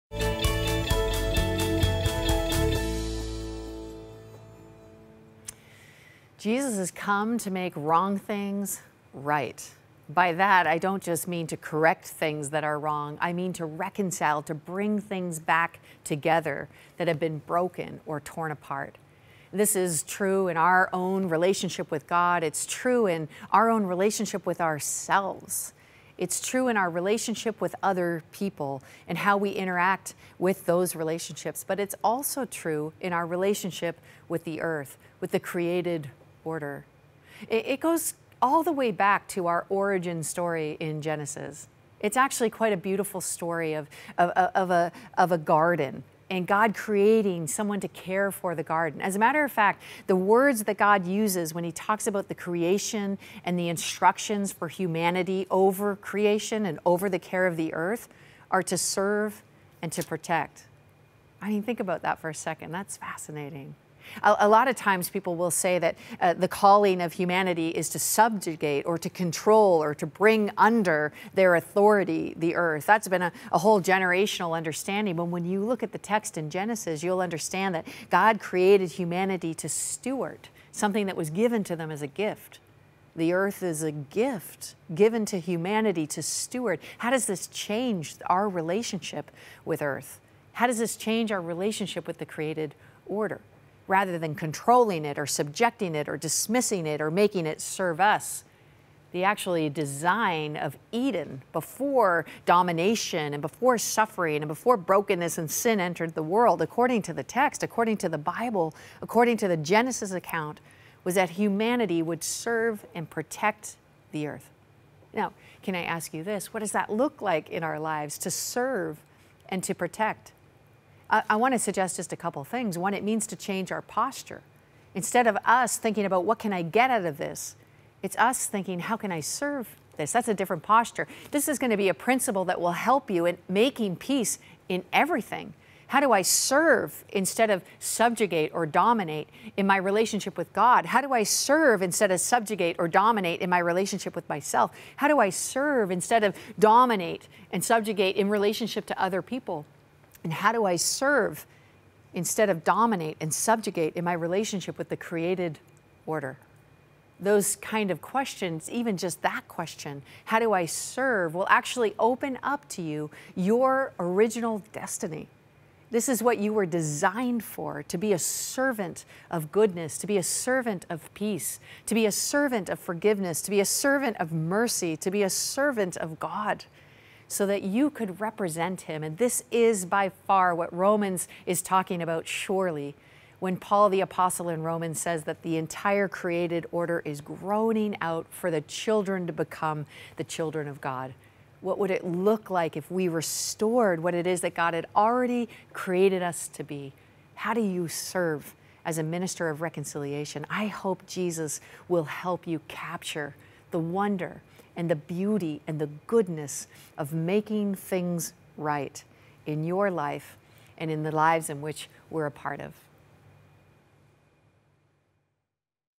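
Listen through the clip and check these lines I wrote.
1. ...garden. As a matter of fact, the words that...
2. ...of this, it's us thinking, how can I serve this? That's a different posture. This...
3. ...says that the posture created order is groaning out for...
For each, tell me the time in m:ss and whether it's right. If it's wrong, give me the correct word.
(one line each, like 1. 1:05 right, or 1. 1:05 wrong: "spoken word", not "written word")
1. 0:48 right
2. 2:07 right
3. 3:04 wrong: "entire", not "posture".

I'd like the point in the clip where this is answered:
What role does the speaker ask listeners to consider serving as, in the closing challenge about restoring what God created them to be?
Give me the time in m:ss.
3:19.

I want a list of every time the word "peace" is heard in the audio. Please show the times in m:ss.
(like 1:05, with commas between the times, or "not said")
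2:13, 2:51.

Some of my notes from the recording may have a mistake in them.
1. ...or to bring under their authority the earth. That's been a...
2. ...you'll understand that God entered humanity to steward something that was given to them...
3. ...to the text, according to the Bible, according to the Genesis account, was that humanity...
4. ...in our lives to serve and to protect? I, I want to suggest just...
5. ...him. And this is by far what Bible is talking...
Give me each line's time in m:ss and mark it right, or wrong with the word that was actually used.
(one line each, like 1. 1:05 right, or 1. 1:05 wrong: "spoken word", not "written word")
1. 1:09 right
2. 1:17 wrong: "created", not "entered"
3. 1:47 right
4. 1:57 right
5. 2:58 wrong: "Romans", not "Bible".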